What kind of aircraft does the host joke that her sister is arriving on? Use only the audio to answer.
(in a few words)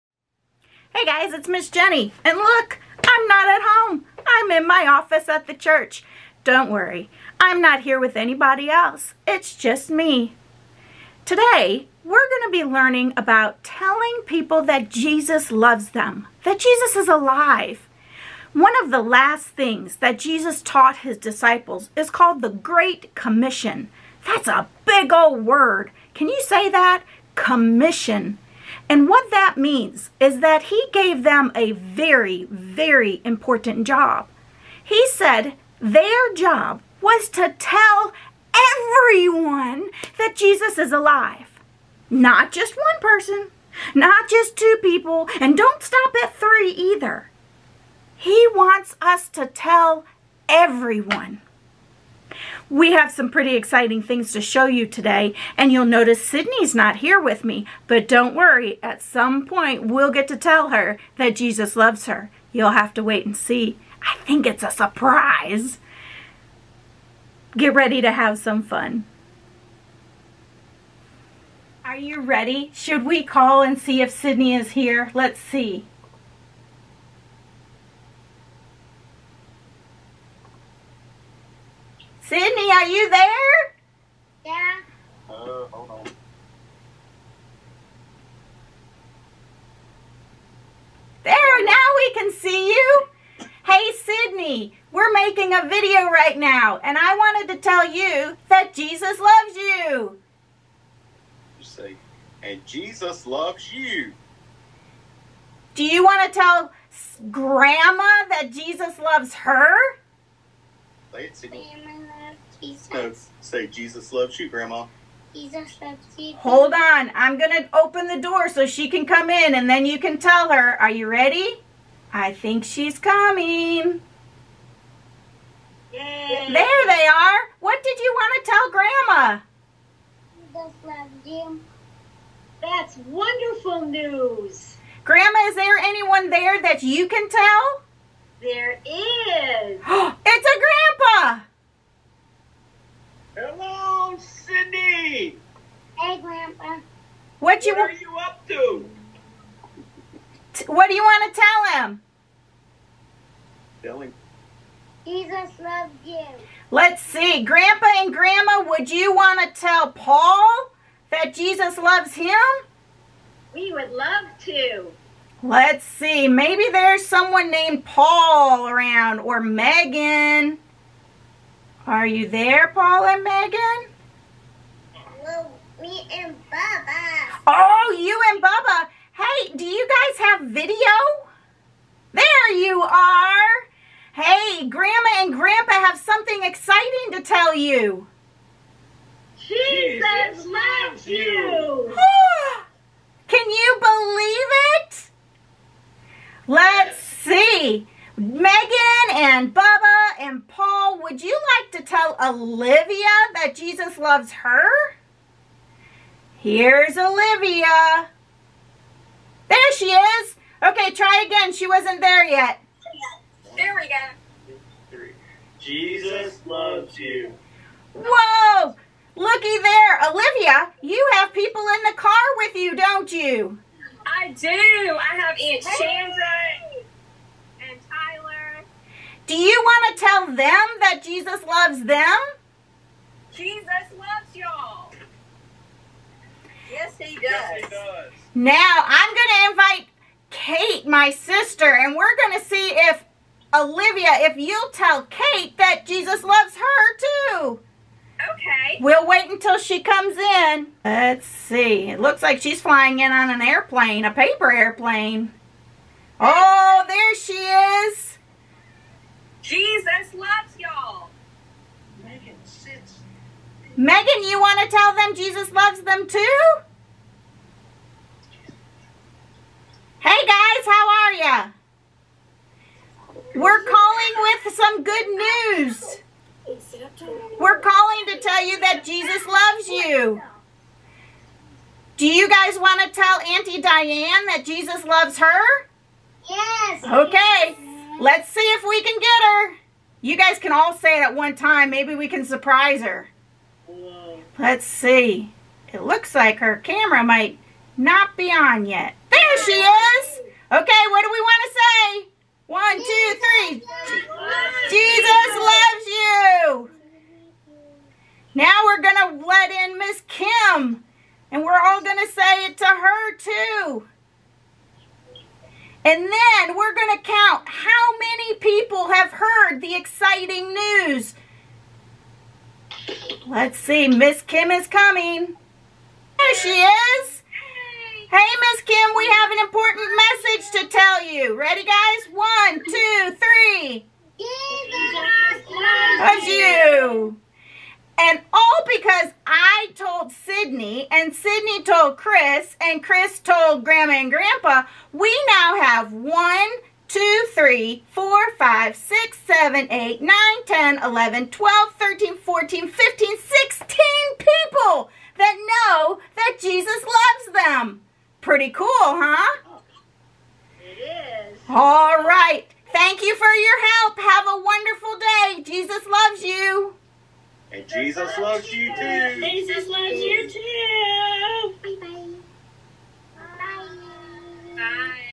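paper airplane.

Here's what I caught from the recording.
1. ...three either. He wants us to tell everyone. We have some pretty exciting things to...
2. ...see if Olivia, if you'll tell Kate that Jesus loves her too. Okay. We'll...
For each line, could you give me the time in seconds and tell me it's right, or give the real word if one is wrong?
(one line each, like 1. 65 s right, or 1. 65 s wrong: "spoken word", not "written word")
1. 46 s right
2. 242 s right.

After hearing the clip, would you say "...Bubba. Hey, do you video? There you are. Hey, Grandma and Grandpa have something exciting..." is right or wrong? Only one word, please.
right.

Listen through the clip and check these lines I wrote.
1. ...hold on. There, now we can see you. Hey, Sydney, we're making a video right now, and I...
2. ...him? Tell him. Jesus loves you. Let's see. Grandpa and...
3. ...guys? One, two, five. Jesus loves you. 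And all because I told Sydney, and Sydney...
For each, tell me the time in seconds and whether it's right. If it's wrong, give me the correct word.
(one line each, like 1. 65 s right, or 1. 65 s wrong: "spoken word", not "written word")
1. 85 s right
2. 151 s right
3. 331 s wrong: "three", not "five".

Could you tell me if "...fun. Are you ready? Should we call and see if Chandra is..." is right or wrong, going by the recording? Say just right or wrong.
wrong.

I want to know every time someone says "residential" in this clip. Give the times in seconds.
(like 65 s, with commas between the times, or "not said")
not said.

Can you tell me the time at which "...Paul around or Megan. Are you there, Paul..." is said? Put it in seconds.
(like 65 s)
167 s.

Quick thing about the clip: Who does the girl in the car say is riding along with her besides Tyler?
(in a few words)
Aunt Chandra.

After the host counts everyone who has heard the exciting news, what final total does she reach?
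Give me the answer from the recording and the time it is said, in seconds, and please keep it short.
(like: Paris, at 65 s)
14, at 352 s.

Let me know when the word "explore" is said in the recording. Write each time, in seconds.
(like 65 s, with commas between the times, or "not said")
not said.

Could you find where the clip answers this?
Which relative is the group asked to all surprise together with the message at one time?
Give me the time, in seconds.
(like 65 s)
283 s.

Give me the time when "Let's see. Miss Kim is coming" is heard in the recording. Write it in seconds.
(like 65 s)
323 s.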